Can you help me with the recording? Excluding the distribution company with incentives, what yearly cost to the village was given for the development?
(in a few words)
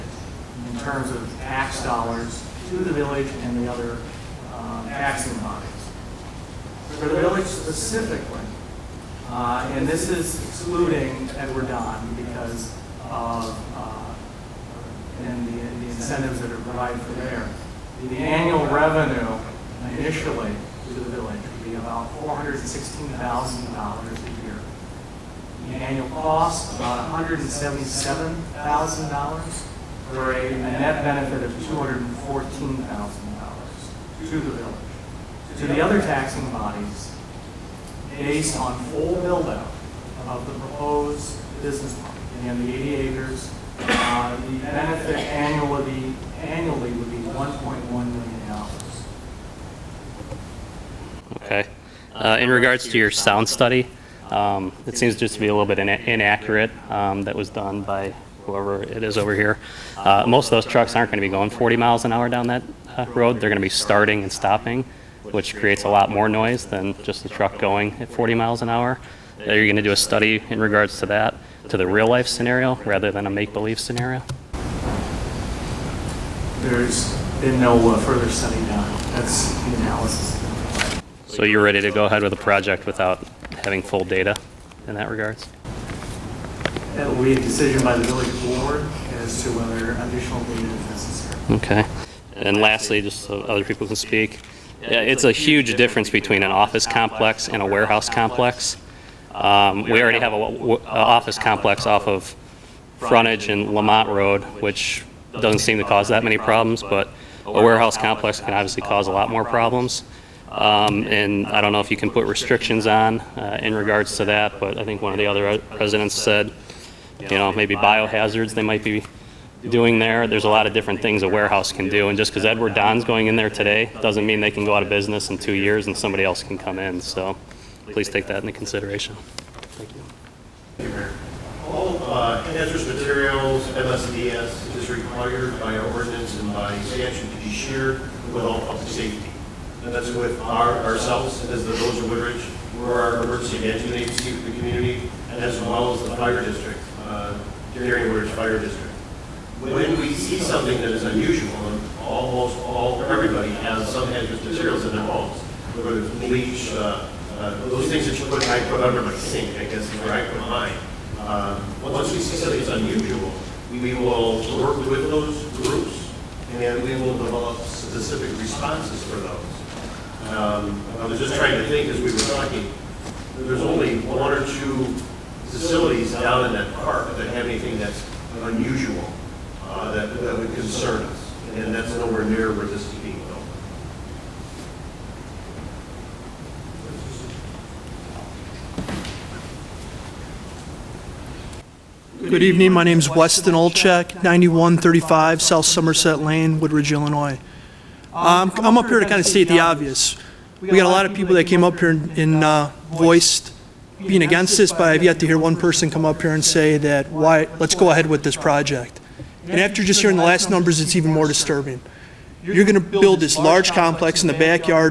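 $177,000.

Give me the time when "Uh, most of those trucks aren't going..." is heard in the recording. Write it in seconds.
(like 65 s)
59 s.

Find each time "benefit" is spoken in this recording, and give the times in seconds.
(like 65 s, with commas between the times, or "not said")
31 s, 44 s.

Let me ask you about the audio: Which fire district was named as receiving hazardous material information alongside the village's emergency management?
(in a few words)
Gary Woodridge Fire District.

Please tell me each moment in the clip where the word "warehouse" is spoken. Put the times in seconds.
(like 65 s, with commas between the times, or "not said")
97 s, 107 s, 121 s.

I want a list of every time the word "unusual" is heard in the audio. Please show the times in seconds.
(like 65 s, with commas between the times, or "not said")
151 s, 162 s, 178 s.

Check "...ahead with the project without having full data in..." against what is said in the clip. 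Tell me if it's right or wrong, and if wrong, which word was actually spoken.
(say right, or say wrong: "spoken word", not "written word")
right.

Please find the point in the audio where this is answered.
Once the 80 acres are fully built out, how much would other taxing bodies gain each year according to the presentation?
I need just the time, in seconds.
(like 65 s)
47 s.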